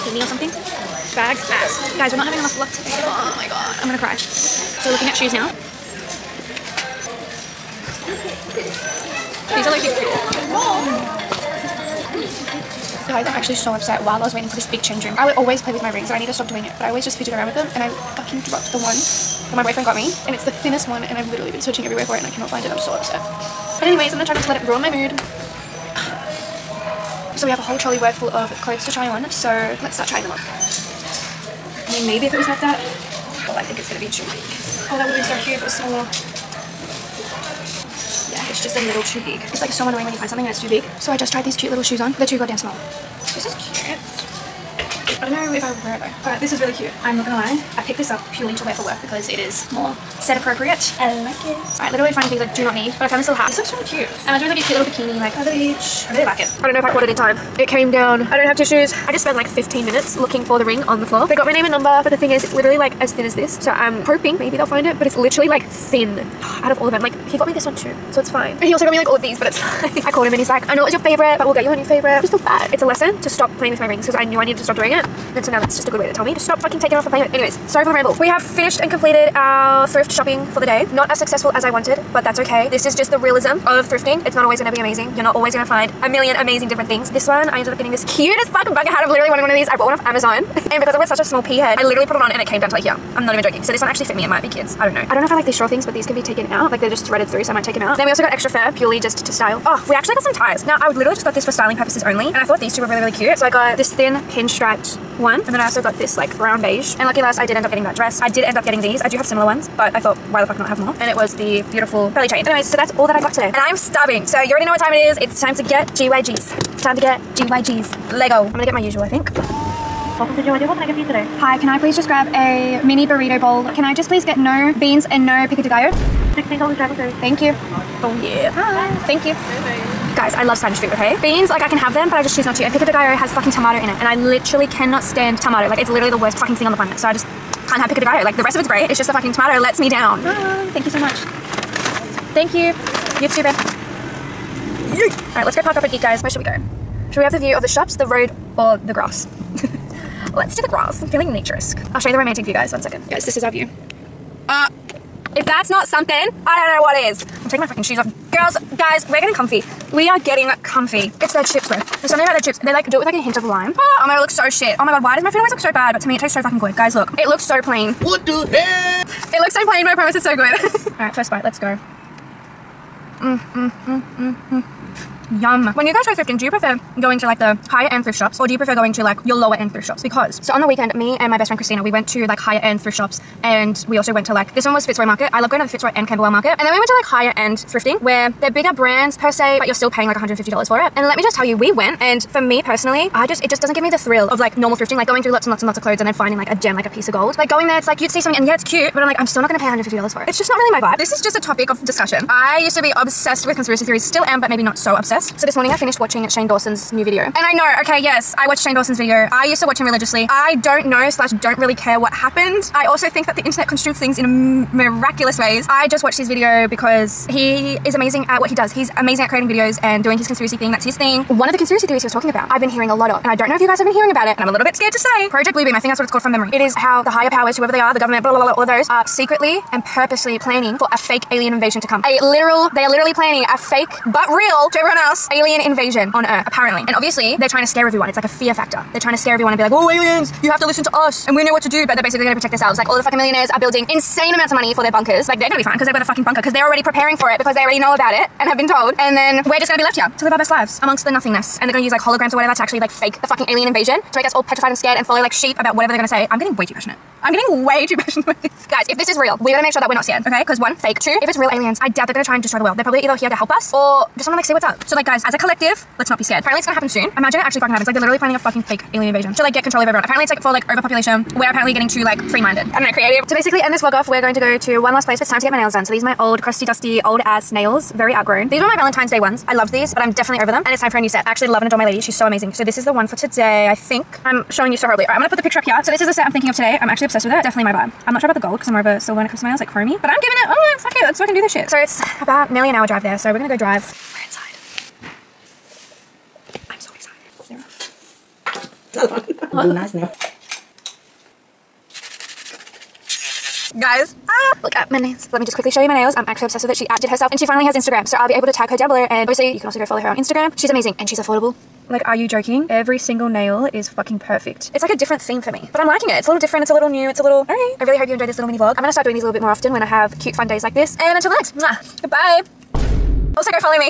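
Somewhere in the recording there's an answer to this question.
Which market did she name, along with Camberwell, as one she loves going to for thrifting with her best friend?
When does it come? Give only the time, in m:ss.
3:04.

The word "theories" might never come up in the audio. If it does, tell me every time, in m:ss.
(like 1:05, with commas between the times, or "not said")
3:23, 3:41.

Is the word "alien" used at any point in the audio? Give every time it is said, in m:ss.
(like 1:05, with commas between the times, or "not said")
3:51, 3:55, 3:59, 4:13, 4:21, 4:28.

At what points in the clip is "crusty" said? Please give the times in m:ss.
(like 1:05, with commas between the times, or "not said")
4:36.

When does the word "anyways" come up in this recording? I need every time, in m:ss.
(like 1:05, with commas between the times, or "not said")
0:23, 1:17, 1:52.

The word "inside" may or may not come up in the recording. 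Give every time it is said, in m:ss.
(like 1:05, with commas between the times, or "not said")
4:54.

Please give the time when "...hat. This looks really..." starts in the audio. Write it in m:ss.
0:53.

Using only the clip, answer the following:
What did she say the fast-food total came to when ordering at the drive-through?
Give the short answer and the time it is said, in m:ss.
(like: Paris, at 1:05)
$16, at 2:06.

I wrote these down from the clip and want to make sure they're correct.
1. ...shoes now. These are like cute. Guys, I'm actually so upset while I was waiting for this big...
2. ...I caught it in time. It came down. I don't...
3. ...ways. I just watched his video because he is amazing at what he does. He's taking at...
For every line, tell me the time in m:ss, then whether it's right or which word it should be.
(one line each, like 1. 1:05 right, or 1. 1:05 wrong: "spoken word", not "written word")
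1. 0:05 right
2. 0:56 right
3. 3:35 wrong: "amazing", not "taking".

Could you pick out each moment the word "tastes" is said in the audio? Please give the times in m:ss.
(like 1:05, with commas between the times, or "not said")
2:46.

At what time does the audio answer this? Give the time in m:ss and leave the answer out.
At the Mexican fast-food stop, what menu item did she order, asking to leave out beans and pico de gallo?
2:02.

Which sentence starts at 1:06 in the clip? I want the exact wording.
Like, he got me this one too so it's fine.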